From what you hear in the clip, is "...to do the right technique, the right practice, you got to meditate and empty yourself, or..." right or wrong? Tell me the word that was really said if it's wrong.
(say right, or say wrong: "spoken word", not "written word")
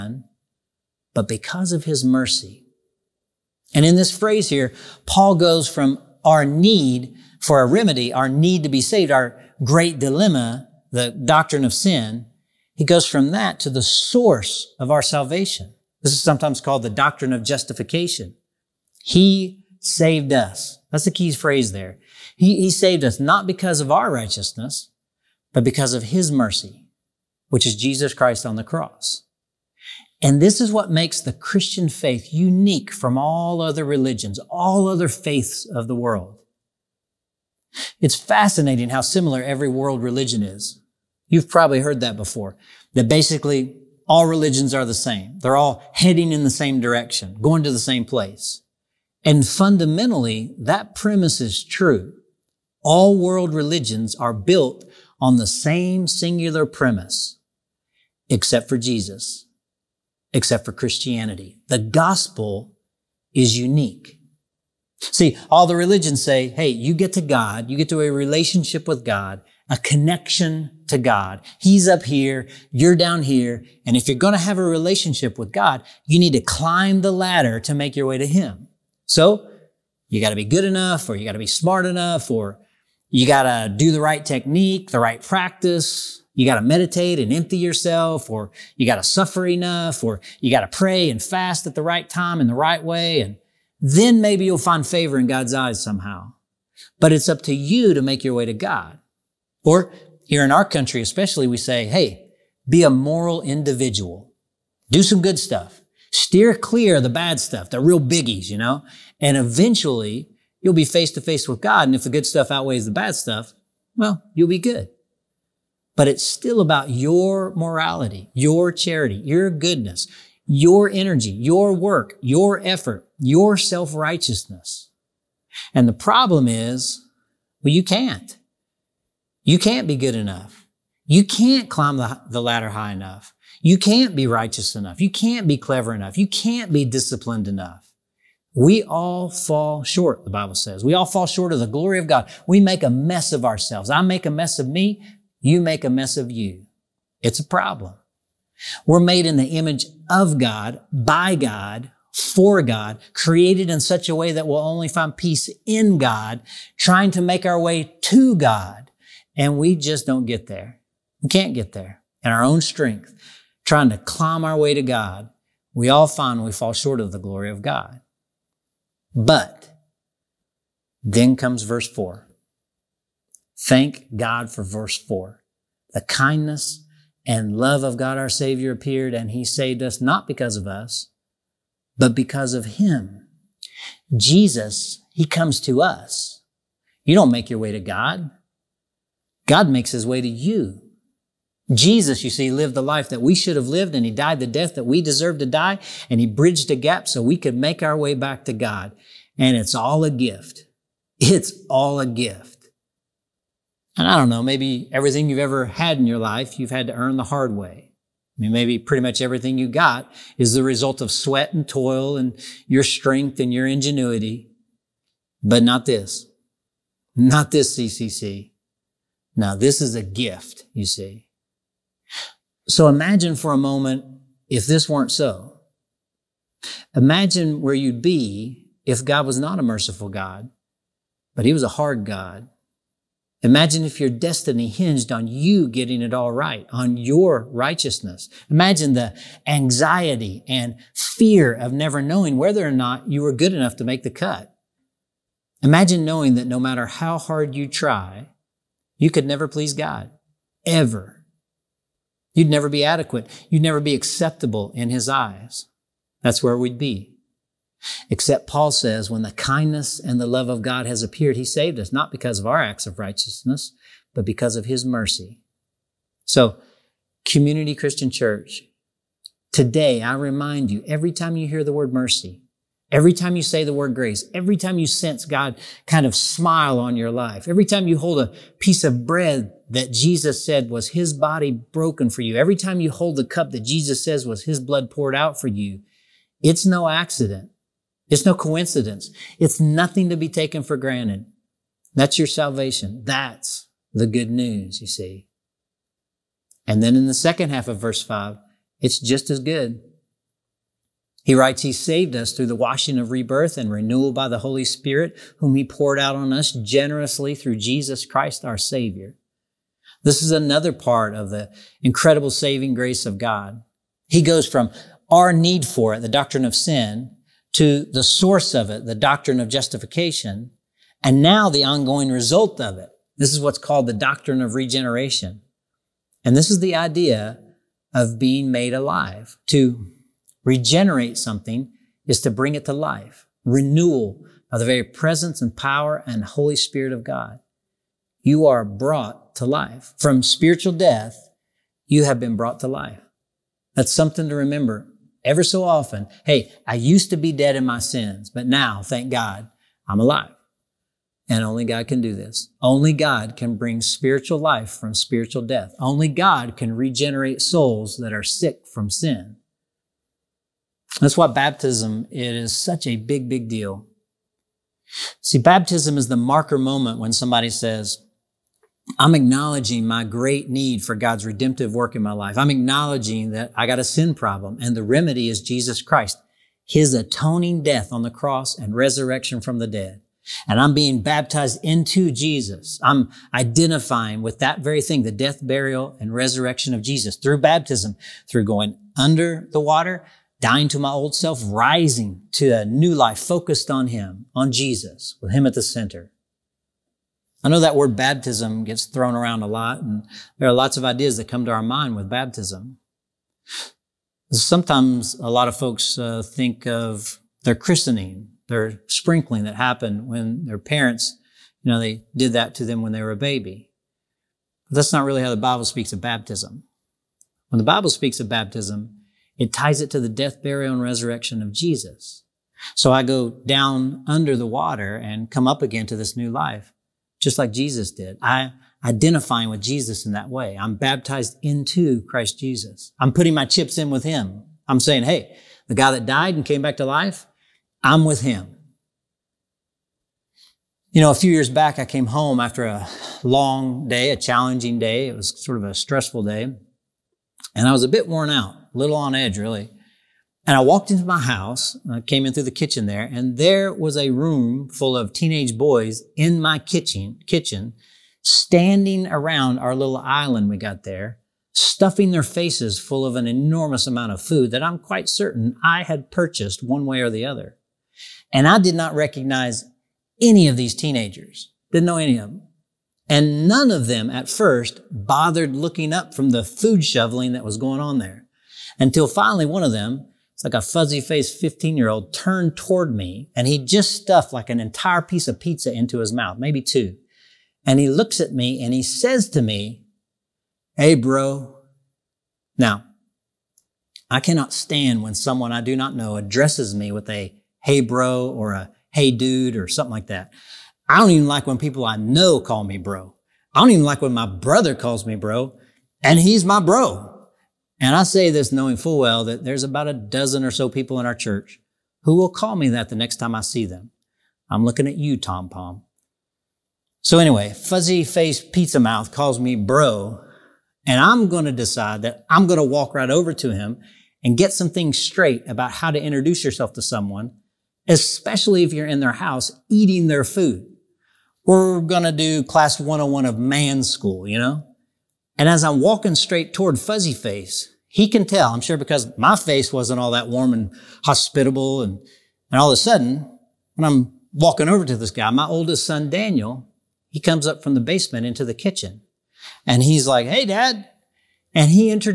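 right.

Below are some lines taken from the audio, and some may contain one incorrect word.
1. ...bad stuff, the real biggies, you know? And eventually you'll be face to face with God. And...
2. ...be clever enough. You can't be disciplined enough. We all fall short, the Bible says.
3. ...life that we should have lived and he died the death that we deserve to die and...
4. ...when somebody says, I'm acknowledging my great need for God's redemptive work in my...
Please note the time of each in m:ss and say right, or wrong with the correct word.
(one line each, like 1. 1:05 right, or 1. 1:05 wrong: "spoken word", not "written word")
1. 1:47 right
2. 2:15 right
3. 3:12 right
4. 6:06 right.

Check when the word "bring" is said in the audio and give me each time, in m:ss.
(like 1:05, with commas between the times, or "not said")
5:32, 5:53.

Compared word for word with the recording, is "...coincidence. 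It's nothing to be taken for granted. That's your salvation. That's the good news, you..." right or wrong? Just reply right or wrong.
right.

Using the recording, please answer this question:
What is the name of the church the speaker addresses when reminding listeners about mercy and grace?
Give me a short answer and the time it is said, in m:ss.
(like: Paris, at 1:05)
Community Christian Church, at 4:27.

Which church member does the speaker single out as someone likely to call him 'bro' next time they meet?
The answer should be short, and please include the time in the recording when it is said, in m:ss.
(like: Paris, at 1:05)
Tom Palm, at 8:35.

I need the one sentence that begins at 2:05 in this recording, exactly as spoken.
And the problem is, well, you can't.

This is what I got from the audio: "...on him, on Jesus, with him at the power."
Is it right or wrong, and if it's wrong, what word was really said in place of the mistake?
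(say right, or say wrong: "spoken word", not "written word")
wrong: "center", not "power".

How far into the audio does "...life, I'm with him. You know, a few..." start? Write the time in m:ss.
7:16.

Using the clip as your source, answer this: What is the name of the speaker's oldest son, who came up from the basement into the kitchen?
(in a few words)
Daniel.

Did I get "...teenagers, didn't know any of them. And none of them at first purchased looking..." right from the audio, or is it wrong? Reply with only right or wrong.
wrong.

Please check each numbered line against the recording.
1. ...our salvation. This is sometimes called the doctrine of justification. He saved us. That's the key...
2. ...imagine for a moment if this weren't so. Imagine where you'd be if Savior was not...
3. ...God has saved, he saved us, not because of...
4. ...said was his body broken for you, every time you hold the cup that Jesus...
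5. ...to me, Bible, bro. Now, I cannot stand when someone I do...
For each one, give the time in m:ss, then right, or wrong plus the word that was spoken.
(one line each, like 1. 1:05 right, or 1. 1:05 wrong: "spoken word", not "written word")
1. 0:14 right
2. 3:42 wrong: "God", not "Savior"
3. 4:20 wrong: "appeared", not "saved"
4. 4:40 right
5. 8:09 wrong: "Hey", not "Bible".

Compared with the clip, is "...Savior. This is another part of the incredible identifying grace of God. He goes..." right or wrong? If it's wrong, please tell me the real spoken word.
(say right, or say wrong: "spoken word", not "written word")
wrong: "saving", not "identifying".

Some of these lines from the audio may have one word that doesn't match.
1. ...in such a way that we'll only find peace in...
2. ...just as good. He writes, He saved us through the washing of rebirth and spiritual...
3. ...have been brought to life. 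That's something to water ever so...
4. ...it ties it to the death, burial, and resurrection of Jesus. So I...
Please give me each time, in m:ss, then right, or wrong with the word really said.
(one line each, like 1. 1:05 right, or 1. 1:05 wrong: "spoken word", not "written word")
1. 2:33 right
2. 4:58 wrong: "renewal", not "spiritual"
3. 5:42 wrong: "remember", not "water"
4. 6:59 right.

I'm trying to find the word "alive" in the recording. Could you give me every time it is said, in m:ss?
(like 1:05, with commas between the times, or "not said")
5:28, 5:49.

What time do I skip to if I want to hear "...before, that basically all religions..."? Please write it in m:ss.
0:42.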